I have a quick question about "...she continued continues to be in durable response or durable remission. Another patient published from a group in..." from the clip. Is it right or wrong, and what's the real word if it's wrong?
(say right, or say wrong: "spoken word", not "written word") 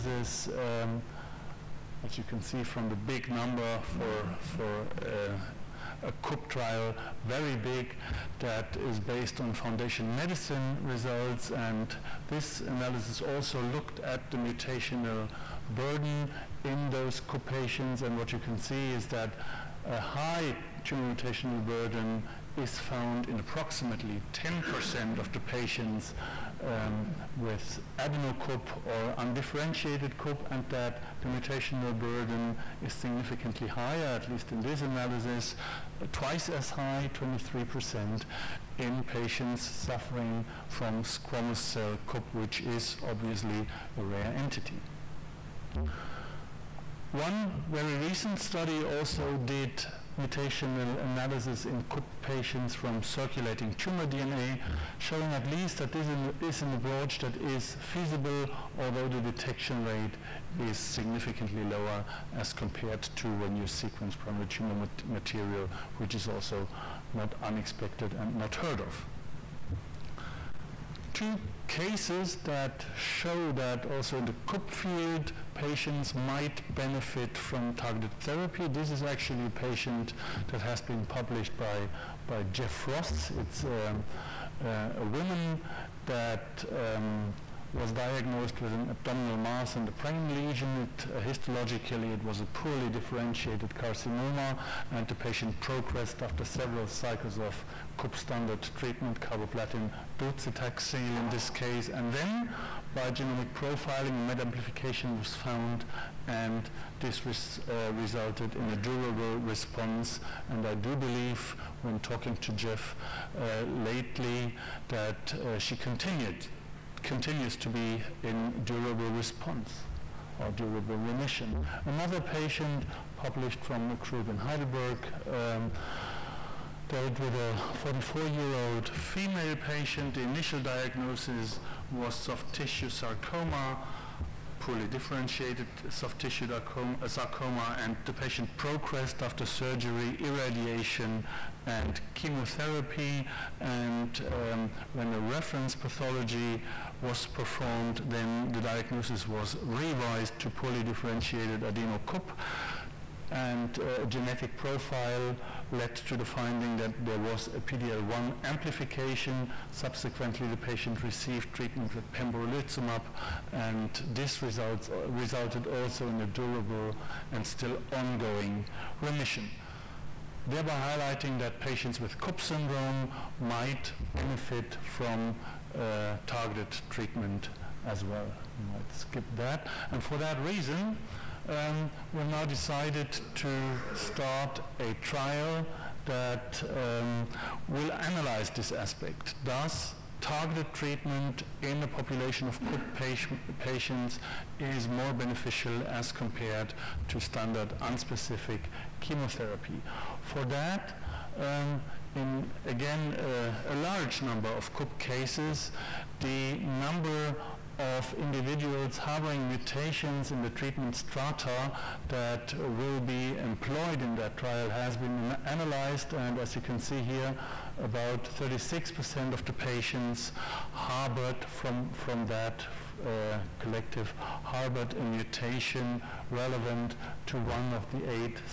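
right.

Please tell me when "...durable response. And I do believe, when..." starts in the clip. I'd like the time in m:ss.
1:48.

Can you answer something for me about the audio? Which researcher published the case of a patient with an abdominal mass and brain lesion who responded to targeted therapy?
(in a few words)
Jeff Ross.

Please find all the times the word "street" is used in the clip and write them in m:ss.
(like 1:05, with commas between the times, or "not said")
not said.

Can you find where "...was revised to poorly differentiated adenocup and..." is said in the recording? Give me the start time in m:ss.
2:29.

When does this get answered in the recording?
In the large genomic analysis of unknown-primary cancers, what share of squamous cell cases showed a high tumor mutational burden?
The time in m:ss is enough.
0:37.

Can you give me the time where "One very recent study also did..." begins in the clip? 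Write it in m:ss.
0:47.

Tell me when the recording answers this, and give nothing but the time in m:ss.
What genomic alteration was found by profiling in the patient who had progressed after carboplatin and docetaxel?
1:44.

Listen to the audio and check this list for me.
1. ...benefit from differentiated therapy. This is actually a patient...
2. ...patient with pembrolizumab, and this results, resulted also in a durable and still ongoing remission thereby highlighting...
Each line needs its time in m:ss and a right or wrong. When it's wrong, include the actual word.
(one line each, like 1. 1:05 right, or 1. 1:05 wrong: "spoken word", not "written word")
1. 1:16 wrong: "targeted", not "differentiated"
2. 2:41 wrong: "treatment", not "patient".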